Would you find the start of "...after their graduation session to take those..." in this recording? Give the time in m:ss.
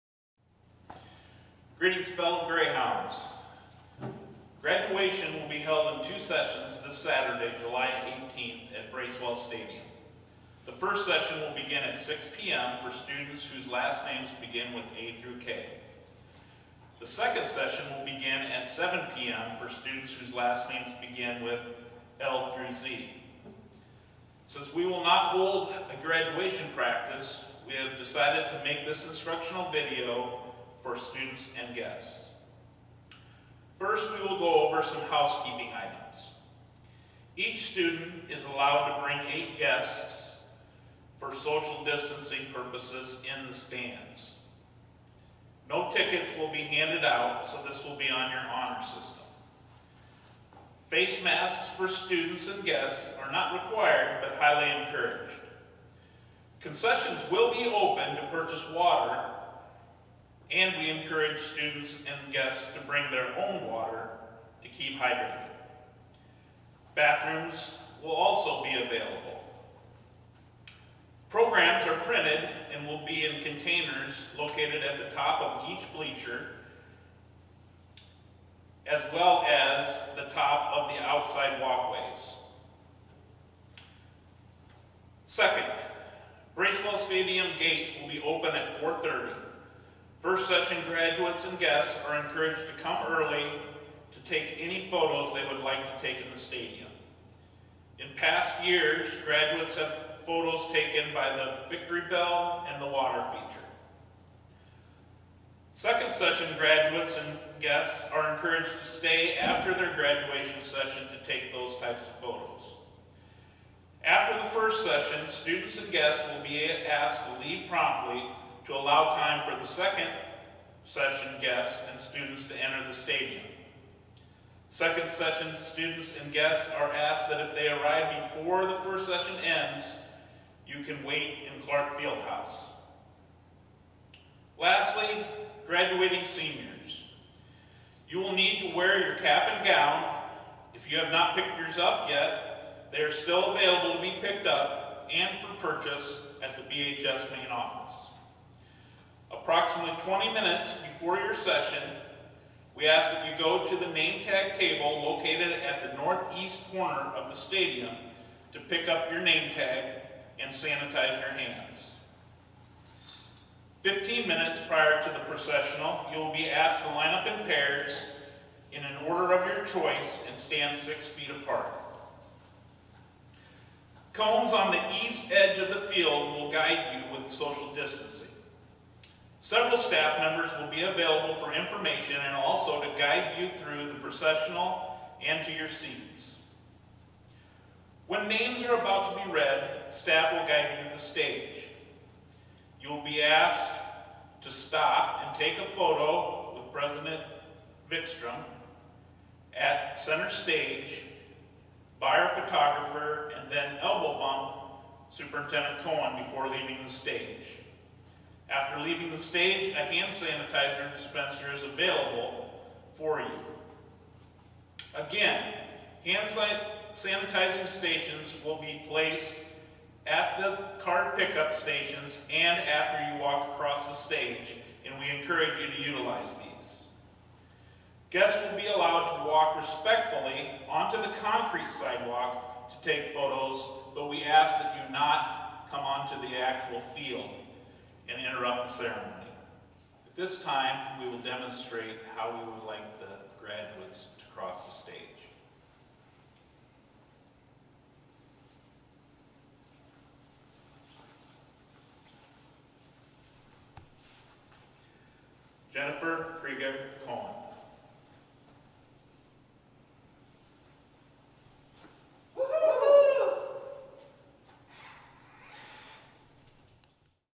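1:49.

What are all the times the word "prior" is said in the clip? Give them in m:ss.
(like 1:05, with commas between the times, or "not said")
2:44.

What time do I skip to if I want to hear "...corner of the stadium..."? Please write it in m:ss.
2:36.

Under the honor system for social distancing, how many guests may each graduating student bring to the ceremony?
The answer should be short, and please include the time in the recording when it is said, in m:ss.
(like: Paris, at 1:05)
8, at 0:39.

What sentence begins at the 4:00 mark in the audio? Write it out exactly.
At this time, we will demonstrate how we would like the graduates to cross the stage.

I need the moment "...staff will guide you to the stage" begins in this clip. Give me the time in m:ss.
3:09.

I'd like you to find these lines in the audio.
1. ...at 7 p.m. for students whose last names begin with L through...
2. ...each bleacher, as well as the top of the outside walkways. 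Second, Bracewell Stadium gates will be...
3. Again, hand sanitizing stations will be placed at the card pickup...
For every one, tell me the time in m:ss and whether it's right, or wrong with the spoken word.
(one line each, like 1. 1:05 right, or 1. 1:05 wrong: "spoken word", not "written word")
1. 0:18 right
2. 1:15 right
3. 3:34 right.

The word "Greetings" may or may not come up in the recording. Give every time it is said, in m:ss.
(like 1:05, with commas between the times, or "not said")
0:01.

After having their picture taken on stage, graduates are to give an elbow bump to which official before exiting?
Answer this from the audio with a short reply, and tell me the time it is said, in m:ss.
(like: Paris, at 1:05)
Superintendent Coen, at 3:25.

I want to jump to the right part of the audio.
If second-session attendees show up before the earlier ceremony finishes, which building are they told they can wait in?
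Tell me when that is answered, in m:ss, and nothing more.
2:11.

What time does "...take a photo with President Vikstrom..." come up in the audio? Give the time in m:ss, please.
3:15.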